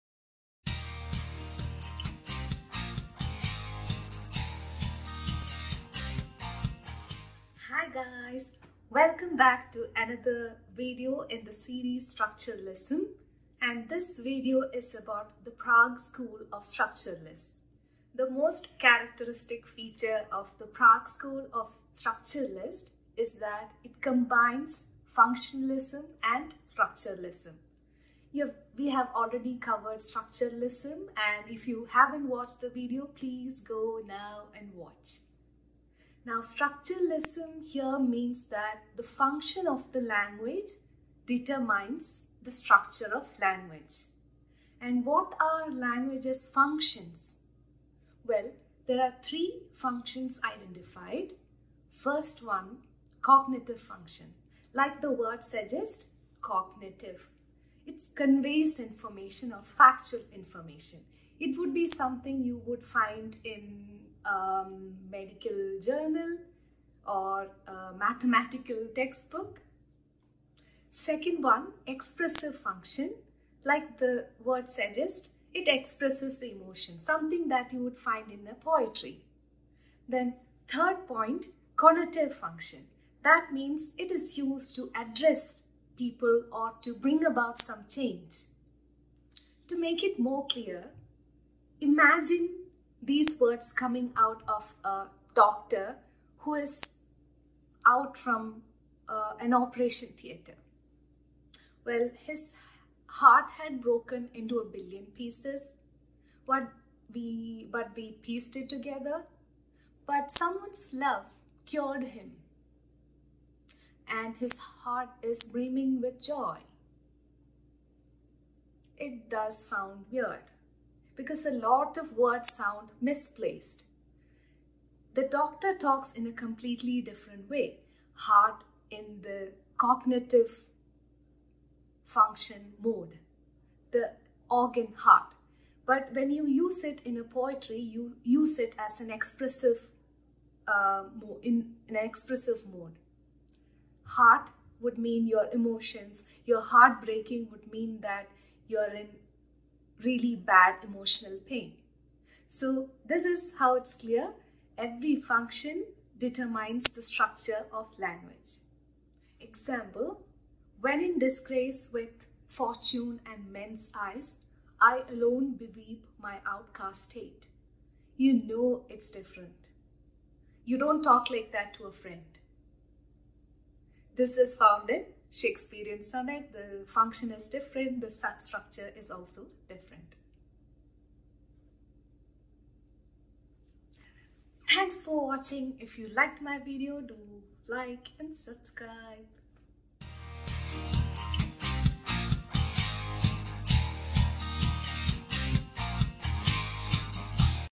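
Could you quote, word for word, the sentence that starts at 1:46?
What we but we pieced it together.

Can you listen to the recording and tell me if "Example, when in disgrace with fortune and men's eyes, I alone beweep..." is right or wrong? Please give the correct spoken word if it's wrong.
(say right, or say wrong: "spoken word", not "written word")
right.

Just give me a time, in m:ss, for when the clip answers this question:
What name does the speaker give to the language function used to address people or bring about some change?
1:21.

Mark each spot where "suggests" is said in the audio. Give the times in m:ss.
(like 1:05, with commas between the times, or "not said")
0:55, 1:14.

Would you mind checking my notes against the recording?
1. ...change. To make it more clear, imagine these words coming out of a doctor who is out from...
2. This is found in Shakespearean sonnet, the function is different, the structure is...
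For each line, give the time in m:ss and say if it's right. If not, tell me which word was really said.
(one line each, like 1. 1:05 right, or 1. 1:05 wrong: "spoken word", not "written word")
1. 1:27 right
2. 2:54 right.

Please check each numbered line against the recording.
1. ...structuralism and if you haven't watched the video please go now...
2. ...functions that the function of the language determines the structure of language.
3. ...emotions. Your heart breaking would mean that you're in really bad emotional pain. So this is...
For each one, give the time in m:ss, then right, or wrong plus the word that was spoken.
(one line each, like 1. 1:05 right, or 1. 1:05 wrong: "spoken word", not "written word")
1. 0:29 right
2. 0:37 wrong: "means", not "functions"
3. 2:25 right.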